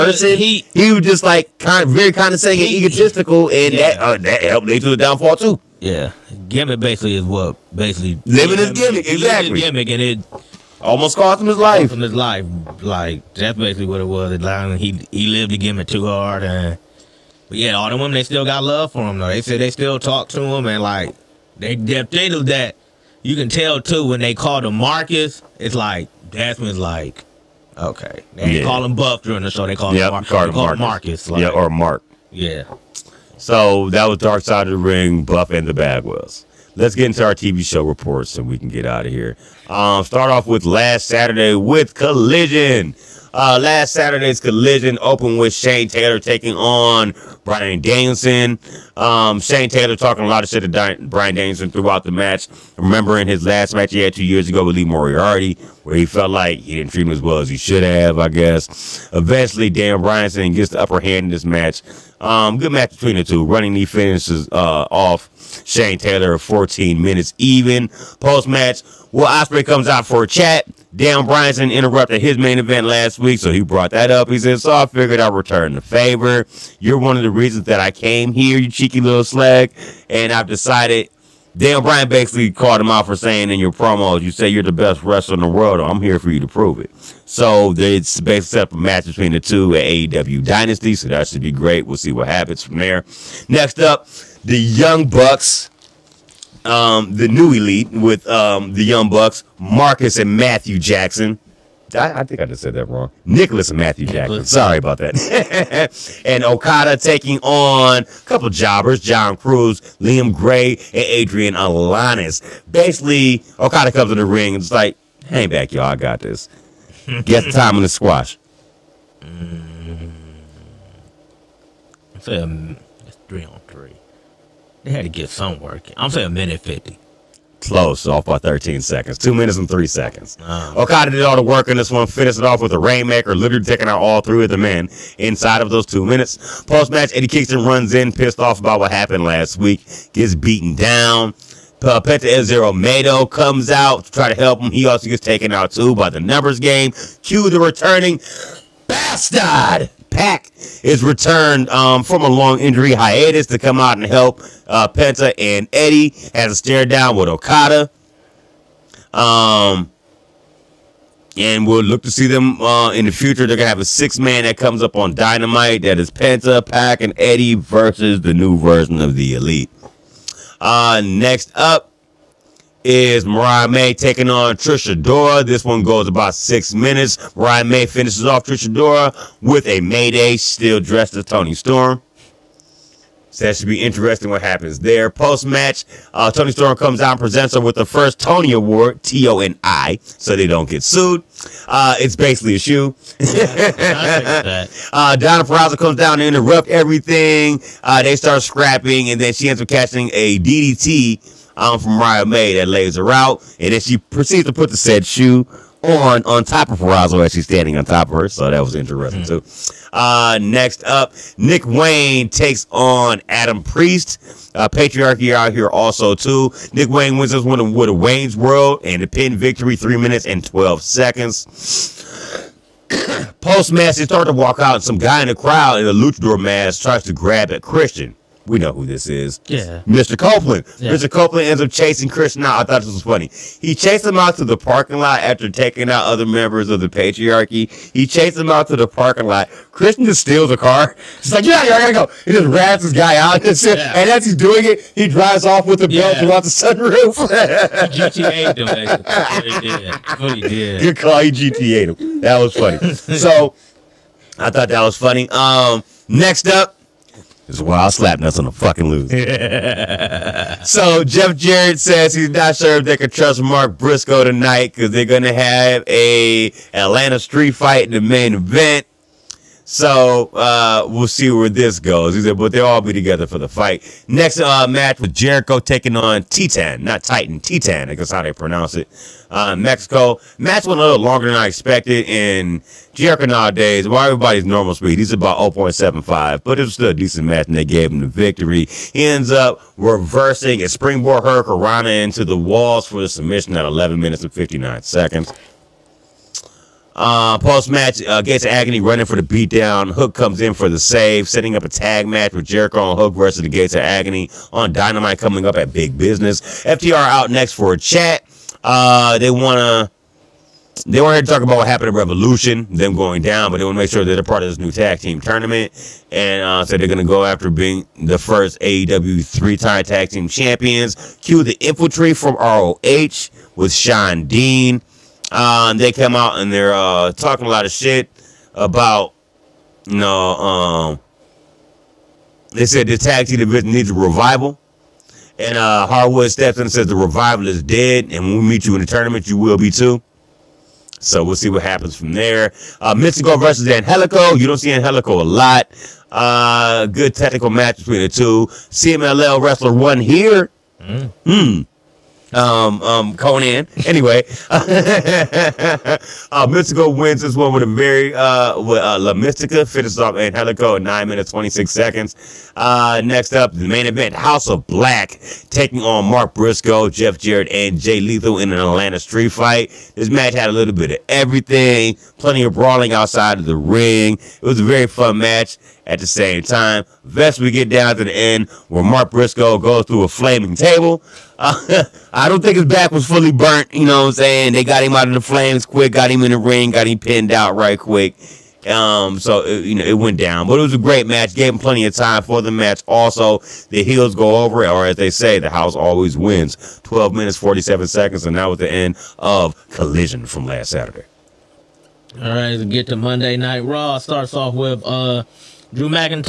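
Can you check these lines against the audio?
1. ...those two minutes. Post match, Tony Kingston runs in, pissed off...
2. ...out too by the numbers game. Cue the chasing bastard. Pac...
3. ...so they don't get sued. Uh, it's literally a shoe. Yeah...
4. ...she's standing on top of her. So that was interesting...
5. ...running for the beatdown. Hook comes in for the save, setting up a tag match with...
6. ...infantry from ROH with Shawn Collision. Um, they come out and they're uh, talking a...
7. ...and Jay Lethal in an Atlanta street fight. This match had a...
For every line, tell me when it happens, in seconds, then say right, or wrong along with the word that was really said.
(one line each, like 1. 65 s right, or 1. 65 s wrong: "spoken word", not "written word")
1. 135 s wrong: "Eddie", not "Tony"
2. 145 s wrong: "returning", not "chasing"
3. 190 s wrong: "basically", not "literally"
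4. 207 s right
5. 298 s right
6. 321 s wrong: "Dean", not "Collision"
7. 367 s right.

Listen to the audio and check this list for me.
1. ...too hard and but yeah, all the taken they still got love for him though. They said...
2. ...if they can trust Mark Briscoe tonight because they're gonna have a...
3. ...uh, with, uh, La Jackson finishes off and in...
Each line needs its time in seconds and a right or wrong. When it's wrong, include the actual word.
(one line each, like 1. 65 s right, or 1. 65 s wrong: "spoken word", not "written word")
1. 15 s wrong: "women", not "taken"
2. 262 s right
3. 358 s wrong: "Mística", not "Jackson".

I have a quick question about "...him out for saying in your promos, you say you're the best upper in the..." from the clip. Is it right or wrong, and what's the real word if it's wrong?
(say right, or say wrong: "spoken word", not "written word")
wrong: "wrestler", not "upper".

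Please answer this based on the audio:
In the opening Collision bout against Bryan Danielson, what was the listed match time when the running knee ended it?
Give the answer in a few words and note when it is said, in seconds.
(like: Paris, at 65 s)
14 minutes, at 66 s.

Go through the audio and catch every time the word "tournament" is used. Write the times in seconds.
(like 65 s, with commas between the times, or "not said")
315 s, 338 s.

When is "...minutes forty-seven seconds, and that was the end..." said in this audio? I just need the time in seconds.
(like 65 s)
397 s.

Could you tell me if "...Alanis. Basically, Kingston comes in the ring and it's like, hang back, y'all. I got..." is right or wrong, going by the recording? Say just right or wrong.
wrong.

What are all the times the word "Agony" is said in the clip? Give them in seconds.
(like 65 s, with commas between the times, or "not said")
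298 s, 303 s.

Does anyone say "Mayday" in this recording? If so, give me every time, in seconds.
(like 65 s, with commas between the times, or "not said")
179 s.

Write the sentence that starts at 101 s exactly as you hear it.
I, I, think I just said that wrong.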